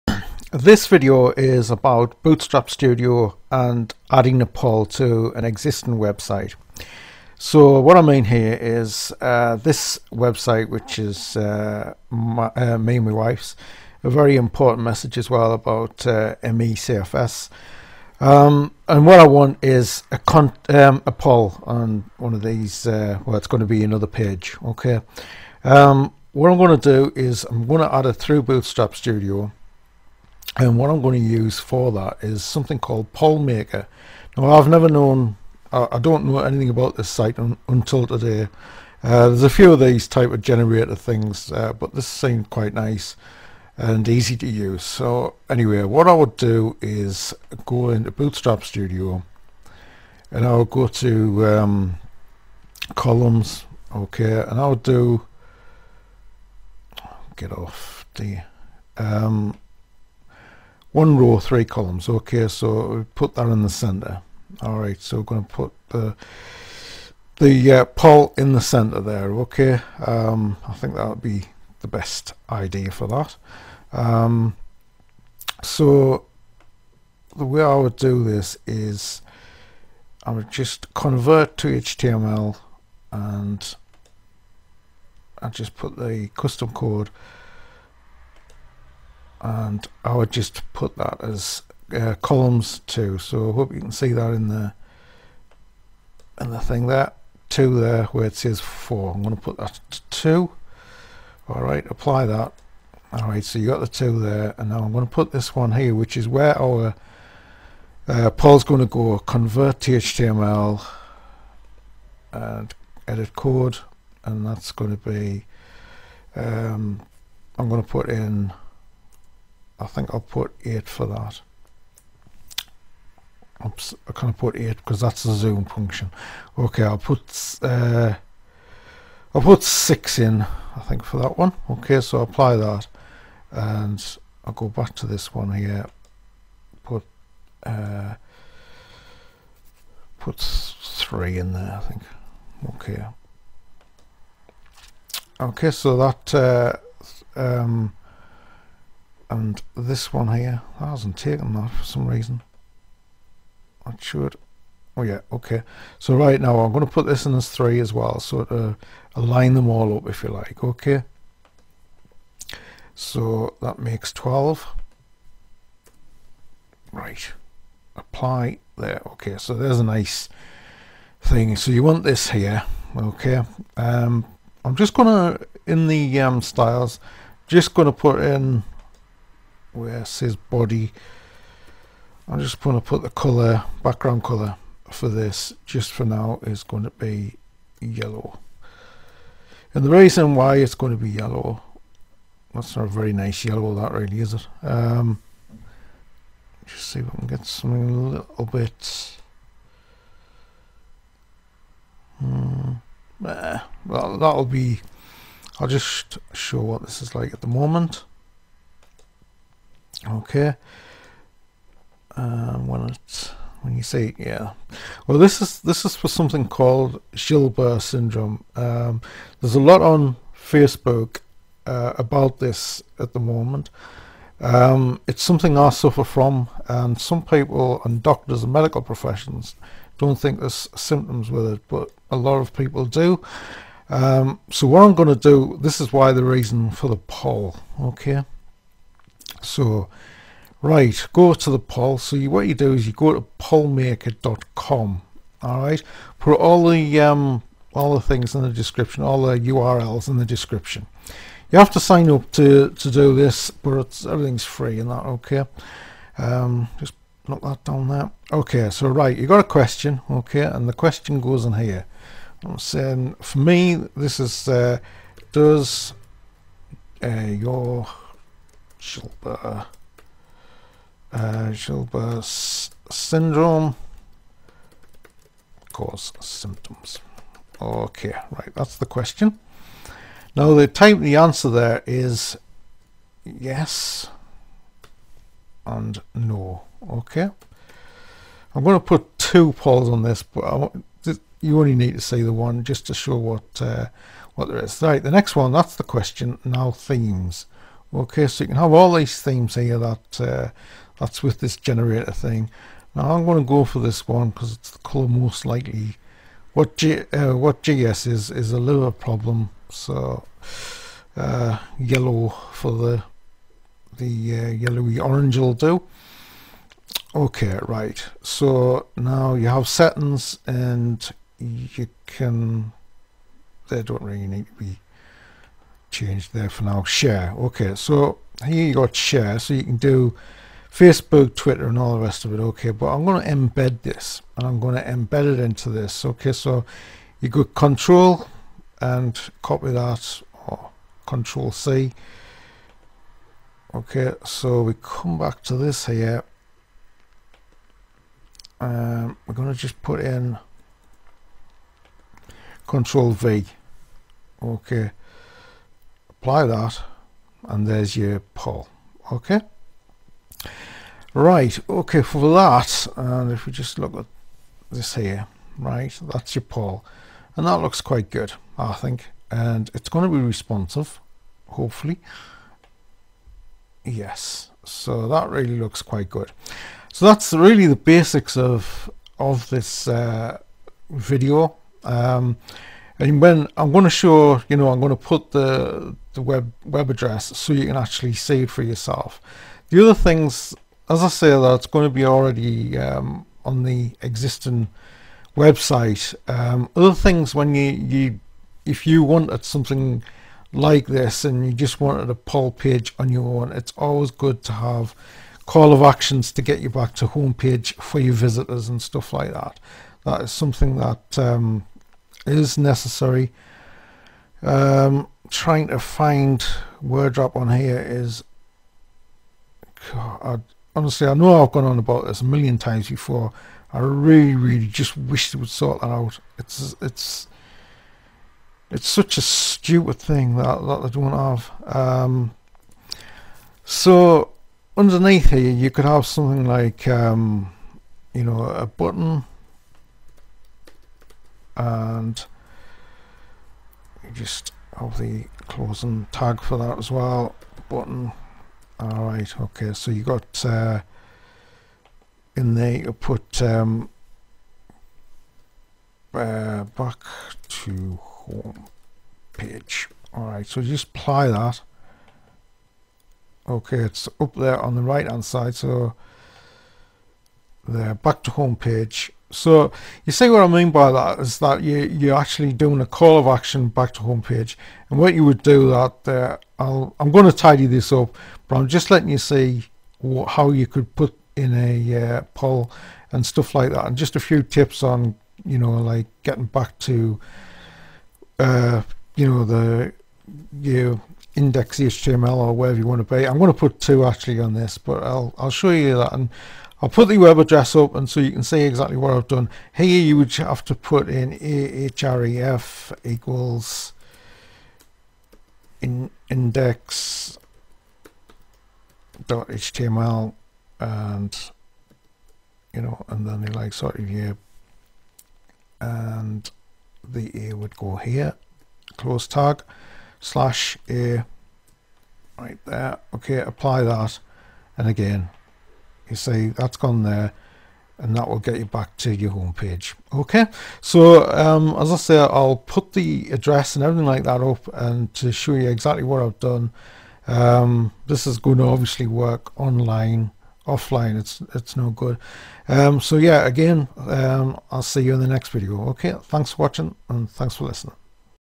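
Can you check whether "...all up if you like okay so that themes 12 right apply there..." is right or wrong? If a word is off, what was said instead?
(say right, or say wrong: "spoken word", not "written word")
wrong: "makes", not "themes".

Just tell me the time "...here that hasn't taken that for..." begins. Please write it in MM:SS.
02:30.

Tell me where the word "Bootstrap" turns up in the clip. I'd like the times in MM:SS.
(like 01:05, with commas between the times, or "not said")
00:02, 00:28, 00:48.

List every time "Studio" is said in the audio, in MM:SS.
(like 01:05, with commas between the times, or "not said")
00:02, 00:28, 00:48.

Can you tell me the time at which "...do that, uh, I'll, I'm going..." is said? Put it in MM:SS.
07:55.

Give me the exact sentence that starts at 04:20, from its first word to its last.
Okay, and the question goes in here.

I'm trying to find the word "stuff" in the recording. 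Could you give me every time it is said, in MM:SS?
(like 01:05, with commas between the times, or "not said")
06:48, 08:03.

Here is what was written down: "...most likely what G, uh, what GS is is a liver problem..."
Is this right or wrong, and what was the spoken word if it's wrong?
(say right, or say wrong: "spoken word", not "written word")
right.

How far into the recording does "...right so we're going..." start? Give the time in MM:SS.
01:04.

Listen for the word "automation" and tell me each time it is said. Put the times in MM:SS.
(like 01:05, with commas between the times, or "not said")
not said.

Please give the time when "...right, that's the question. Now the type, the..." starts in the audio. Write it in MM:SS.
04:38.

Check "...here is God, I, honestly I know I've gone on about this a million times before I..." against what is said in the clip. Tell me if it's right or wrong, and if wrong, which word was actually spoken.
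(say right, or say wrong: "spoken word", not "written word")
right.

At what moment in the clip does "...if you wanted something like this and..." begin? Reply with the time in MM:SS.
06:38.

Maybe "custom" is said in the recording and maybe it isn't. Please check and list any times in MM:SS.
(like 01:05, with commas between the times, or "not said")
01:26.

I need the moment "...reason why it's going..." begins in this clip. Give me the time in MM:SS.
03:09.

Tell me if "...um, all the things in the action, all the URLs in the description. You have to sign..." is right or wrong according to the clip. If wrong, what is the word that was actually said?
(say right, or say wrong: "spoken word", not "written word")
wrong: "description", not "action".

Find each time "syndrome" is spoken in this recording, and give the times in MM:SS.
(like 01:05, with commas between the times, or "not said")
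03:37, 04:32.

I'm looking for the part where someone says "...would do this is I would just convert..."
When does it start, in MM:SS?
01:17.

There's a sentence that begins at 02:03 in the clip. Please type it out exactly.
Oops, I can't put 8 because that's the zoom function.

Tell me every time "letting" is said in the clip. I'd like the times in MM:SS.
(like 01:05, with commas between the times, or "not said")
07:58.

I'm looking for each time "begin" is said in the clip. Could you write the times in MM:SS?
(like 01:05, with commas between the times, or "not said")
not said.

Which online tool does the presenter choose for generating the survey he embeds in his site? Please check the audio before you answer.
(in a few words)
Pollmaker.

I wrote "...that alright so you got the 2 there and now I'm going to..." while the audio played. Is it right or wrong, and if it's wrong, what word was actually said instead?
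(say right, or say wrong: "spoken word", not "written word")
right.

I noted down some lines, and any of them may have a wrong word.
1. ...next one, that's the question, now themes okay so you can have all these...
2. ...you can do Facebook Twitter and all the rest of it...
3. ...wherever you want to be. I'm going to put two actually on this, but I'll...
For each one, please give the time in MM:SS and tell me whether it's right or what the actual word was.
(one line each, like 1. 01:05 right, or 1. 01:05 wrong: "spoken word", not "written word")
1. 04:55 right
2. 05:29 right
3. 08:12 right.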